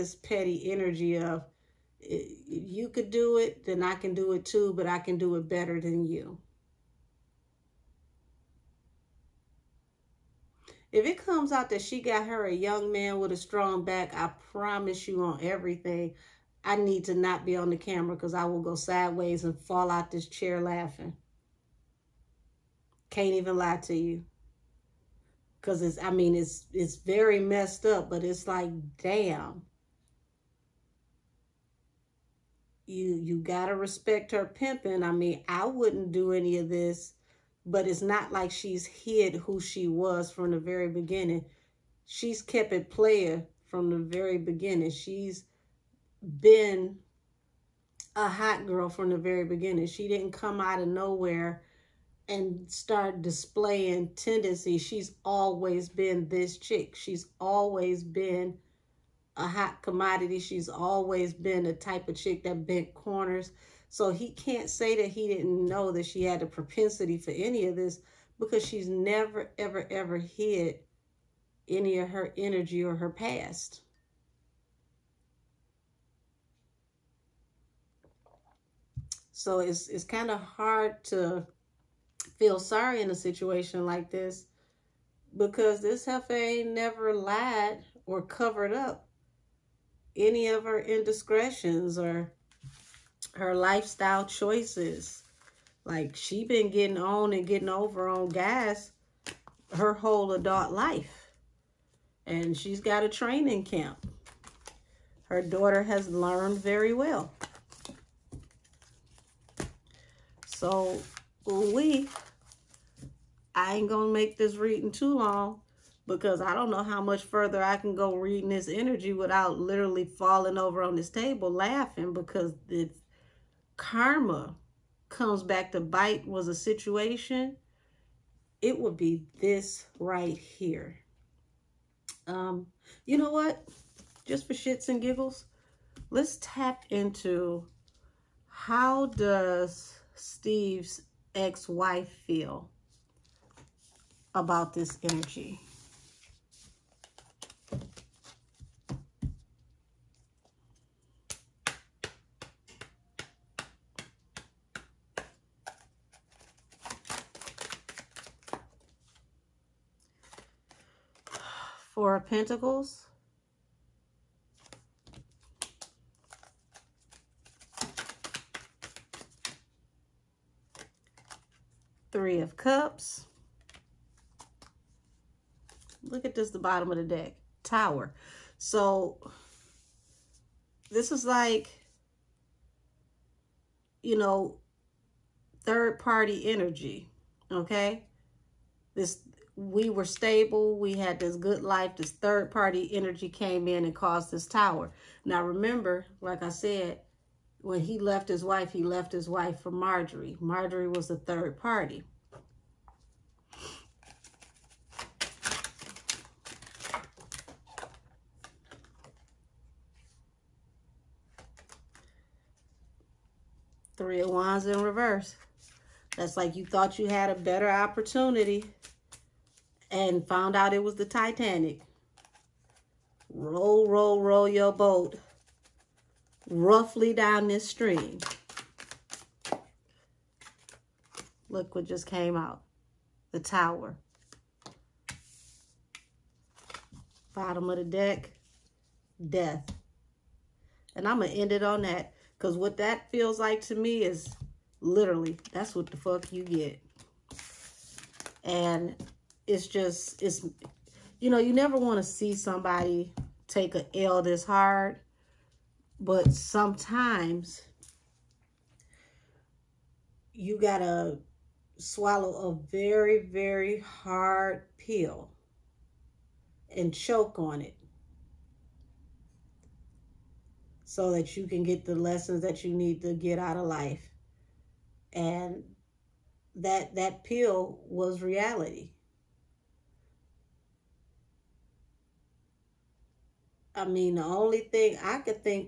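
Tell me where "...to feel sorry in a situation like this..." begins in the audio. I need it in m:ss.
1:21.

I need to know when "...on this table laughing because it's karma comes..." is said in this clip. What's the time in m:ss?
2:00.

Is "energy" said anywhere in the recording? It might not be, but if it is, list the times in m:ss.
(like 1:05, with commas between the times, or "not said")
0:00, 1:12, 1:58, 2:25, 3:06, 3:12.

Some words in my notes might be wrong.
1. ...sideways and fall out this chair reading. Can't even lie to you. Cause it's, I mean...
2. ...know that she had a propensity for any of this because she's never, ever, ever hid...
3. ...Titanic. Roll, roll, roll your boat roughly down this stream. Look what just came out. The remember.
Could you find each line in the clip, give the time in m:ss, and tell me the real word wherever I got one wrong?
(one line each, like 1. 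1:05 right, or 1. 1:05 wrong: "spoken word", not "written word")
1. 0:18 wrong: "laughing", not "reading"
2. 1:05 right
3. 3:41 wrong: "tower", not "remember".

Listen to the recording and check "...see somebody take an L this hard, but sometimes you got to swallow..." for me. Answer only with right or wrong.
right.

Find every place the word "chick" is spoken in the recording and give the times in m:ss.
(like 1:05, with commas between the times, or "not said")
0:56, 1:02.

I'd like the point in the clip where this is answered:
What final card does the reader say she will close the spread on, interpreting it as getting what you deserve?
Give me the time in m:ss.
3:59.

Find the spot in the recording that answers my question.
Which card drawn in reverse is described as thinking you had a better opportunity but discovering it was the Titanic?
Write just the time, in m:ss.
3:33.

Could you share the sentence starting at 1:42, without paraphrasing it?
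And she's got a training camp.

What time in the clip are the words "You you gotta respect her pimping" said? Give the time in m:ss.
0:32.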